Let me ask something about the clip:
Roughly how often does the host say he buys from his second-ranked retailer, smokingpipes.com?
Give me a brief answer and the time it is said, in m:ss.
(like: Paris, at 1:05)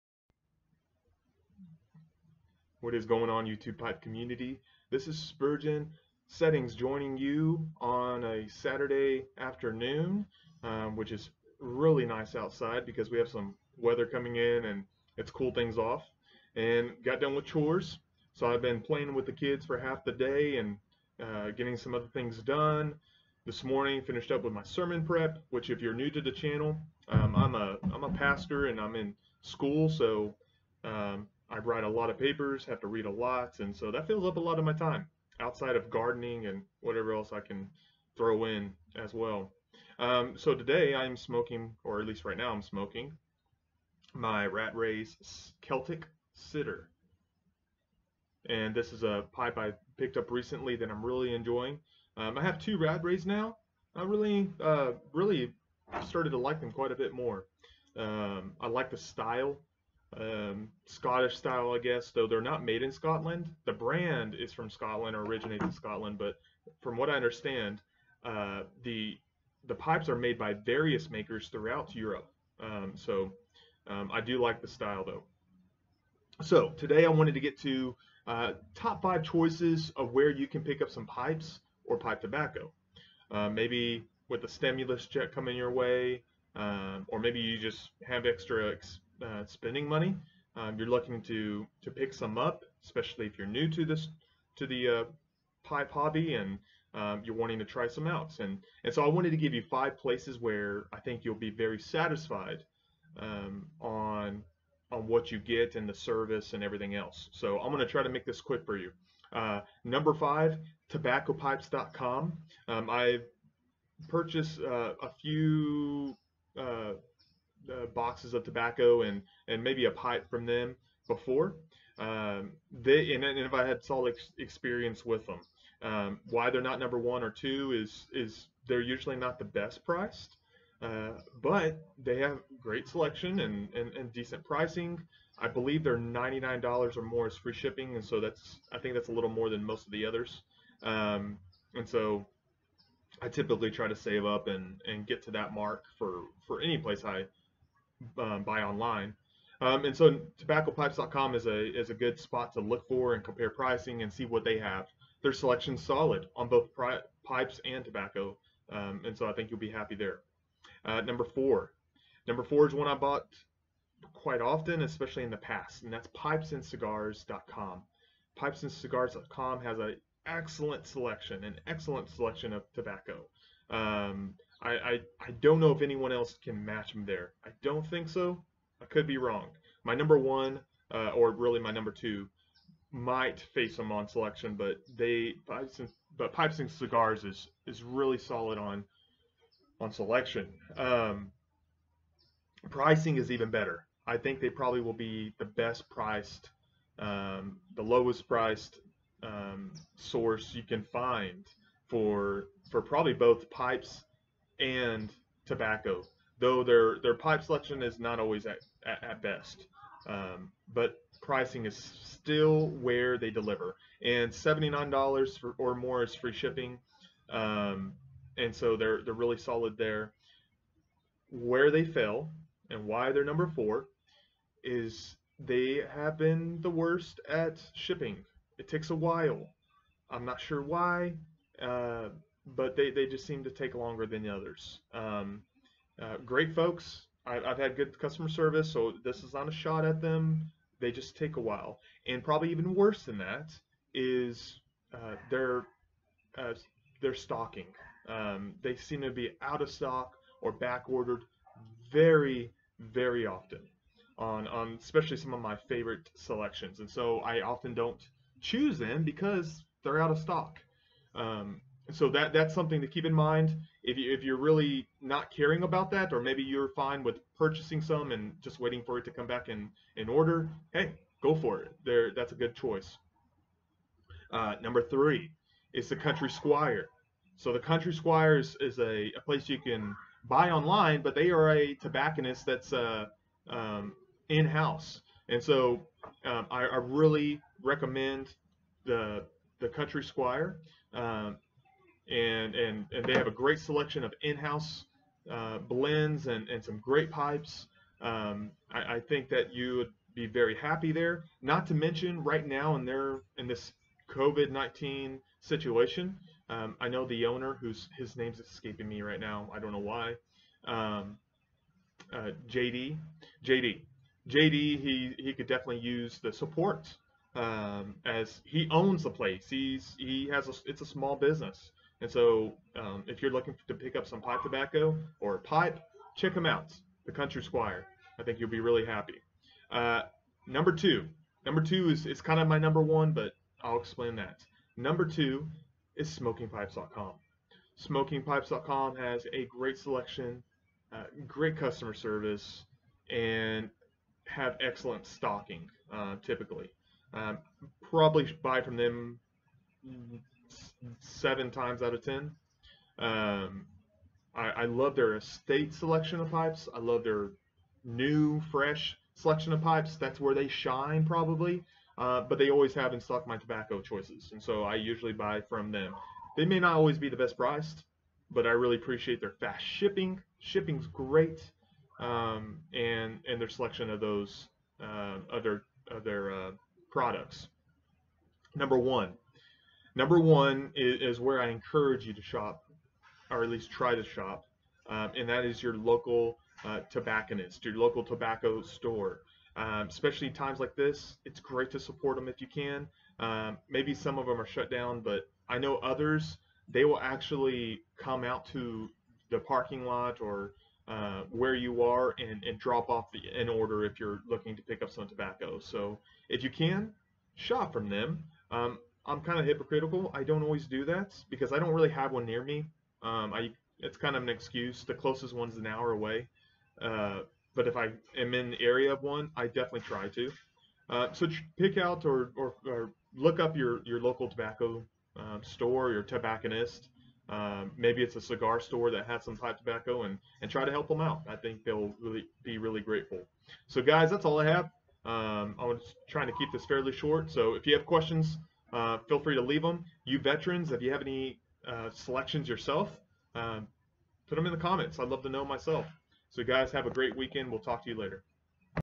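7 out of 10 times, at 5:50.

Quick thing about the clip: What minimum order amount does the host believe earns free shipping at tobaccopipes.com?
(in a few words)
$99.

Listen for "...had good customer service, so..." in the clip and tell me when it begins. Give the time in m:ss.
3:57.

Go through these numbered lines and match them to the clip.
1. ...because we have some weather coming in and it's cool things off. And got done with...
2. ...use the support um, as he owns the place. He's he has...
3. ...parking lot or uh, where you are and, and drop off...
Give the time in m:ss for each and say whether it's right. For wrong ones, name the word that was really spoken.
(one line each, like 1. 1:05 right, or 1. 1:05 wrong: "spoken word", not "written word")
1. 0:12 right
2. 5:15 right
3. 6:39 right.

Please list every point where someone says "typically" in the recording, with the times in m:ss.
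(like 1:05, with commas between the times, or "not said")
2:23, 5:46.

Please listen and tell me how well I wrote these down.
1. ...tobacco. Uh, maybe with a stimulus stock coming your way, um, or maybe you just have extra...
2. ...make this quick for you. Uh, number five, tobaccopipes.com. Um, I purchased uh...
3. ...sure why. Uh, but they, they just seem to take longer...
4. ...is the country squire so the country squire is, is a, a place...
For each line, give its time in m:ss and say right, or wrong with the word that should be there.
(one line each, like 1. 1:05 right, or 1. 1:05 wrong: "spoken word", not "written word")
1. 1:22 wrong: "check", not "stock"
2. 1:48 right
3. 3:50 right
4. 4:35 right.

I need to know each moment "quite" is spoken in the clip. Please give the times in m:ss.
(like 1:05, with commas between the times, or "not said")
0:56, 2:44.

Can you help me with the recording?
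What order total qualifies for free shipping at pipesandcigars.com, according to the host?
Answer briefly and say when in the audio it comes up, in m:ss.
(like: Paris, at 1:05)
$79, at 3:34.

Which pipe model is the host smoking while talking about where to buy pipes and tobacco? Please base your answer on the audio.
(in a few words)
Rattray's Celtic Sitter.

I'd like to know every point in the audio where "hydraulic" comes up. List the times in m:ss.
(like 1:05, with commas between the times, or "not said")
not said.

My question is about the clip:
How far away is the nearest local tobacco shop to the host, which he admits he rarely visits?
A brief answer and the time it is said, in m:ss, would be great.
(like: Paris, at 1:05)
An hour, at 6:55.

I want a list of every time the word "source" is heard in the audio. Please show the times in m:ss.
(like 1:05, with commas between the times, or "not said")
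3:19.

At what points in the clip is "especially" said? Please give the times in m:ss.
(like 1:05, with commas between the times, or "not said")
1:32, 2:44, 4:14, 6:29.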